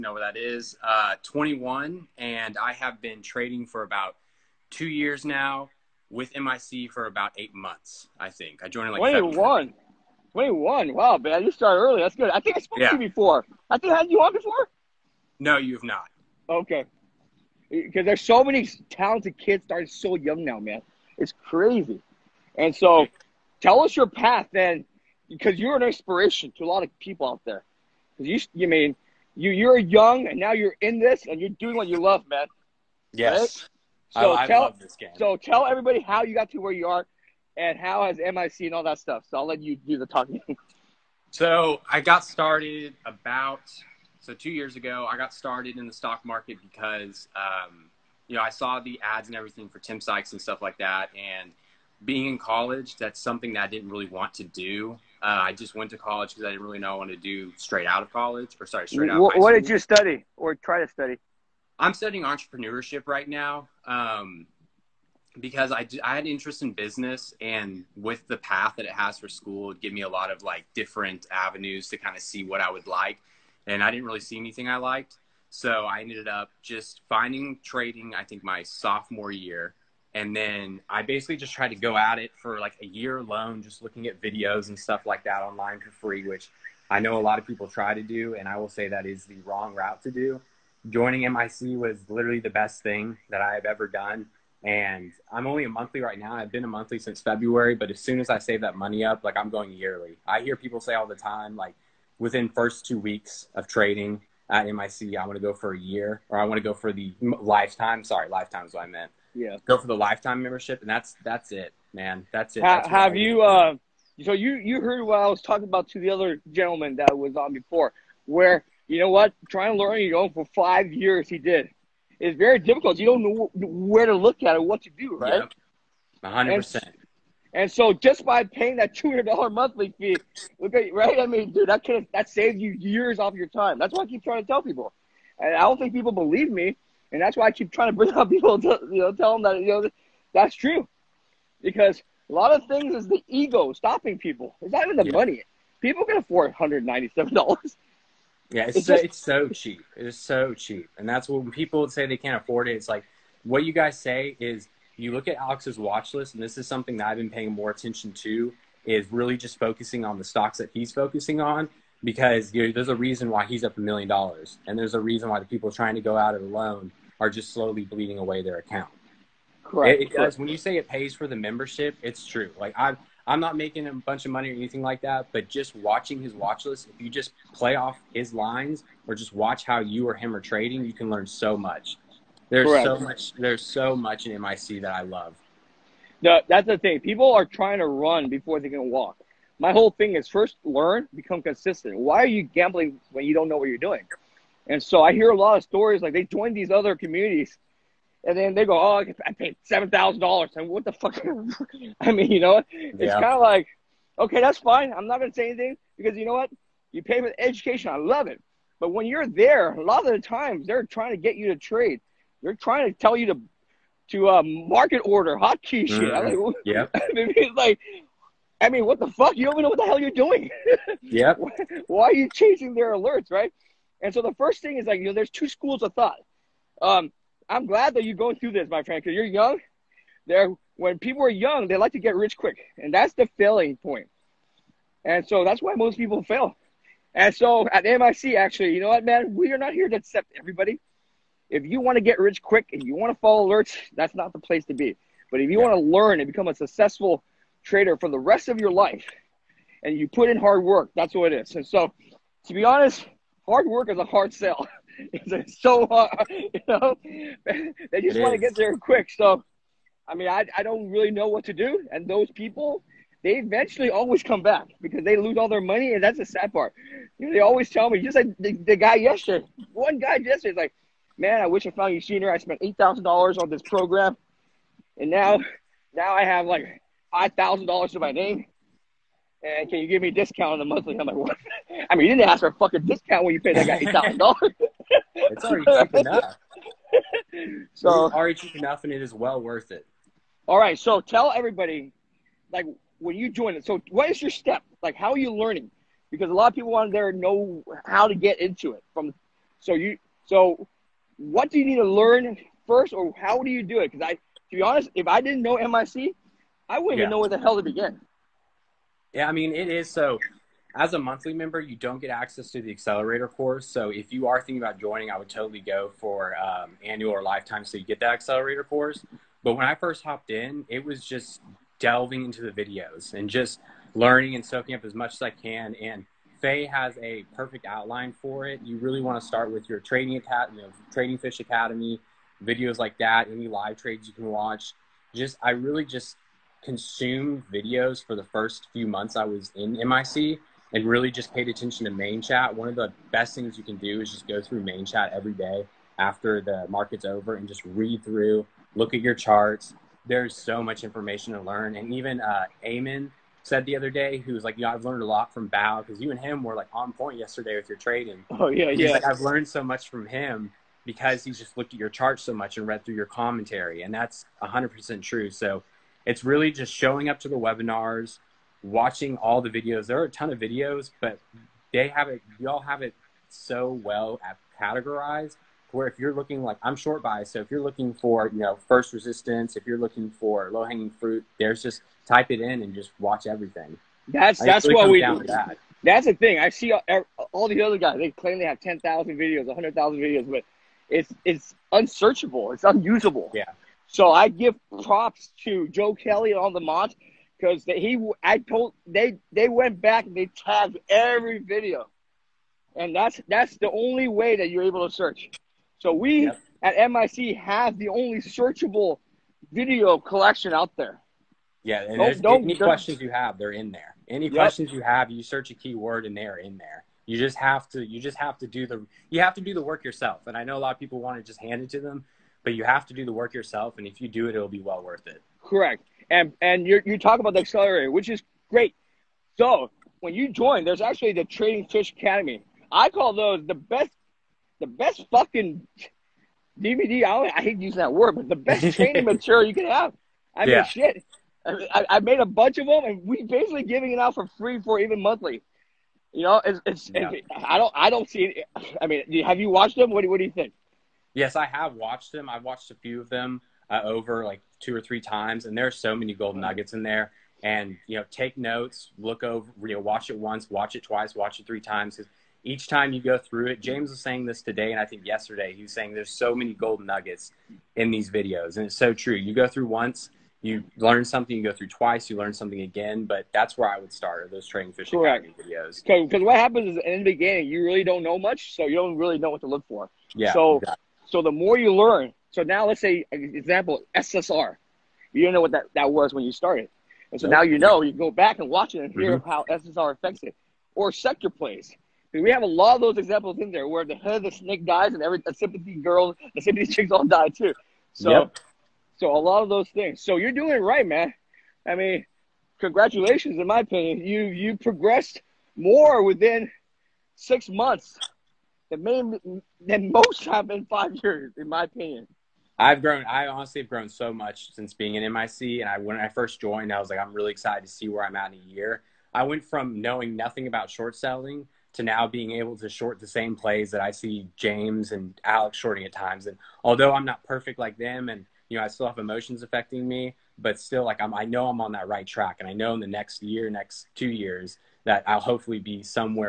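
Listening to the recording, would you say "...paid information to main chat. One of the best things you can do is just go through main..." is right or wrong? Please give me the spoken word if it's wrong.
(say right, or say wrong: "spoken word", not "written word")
wrong: "attention", not "information".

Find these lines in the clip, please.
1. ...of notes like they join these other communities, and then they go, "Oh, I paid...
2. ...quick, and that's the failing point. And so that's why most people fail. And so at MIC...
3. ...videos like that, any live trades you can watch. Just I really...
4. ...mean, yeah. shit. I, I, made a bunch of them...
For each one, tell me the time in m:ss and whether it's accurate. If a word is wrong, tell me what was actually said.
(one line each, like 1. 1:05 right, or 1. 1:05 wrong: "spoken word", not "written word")
1. 3:15 wrong: "stories", not "notes"
2. 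3:52 right
3. 5:32 right
4. 7:20 right.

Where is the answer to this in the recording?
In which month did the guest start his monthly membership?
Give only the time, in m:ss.
1:37.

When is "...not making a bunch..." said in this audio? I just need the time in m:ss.
2:53.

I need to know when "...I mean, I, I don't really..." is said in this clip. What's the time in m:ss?
4:20.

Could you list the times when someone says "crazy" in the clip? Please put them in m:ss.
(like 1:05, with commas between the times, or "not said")
0:21.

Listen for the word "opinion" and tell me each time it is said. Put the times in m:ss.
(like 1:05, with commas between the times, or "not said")
8:23, 8:31.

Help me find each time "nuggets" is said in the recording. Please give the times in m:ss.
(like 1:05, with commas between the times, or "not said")
7:36, 7:46.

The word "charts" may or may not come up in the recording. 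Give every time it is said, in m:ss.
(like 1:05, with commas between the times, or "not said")
5:49, 6:01.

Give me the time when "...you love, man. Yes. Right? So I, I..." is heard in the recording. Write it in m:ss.
0:31.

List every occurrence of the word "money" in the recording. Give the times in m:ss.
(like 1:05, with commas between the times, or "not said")
1:38, 2:25, 2:54, 4:25.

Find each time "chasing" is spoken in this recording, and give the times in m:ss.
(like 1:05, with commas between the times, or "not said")
3:42.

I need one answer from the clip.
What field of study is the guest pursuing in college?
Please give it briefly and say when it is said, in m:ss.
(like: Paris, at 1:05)
Entrepreneurship, at 1:02.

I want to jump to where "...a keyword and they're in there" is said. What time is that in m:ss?
6:55.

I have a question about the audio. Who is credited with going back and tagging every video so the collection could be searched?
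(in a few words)
Joe Kelly.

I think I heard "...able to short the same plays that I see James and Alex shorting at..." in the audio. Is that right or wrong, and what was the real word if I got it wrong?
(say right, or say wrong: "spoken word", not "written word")
right.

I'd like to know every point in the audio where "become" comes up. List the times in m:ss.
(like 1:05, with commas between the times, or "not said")
3:11, 4:06.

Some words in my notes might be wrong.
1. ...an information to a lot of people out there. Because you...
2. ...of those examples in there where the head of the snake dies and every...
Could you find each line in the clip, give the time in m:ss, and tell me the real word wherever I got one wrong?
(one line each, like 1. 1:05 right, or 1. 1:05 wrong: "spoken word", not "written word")
1. 0:25 wrong: "inspiration", not "information"
2. 8:12 right.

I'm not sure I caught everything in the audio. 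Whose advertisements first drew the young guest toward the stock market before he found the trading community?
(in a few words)
Tim Sykes.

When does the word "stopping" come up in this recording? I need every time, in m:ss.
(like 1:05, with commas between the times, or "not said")
2:23.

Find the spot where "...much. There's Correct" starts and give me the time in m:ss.
3:01.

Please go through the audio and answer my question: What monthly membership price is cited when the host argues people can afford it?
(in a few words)
$197.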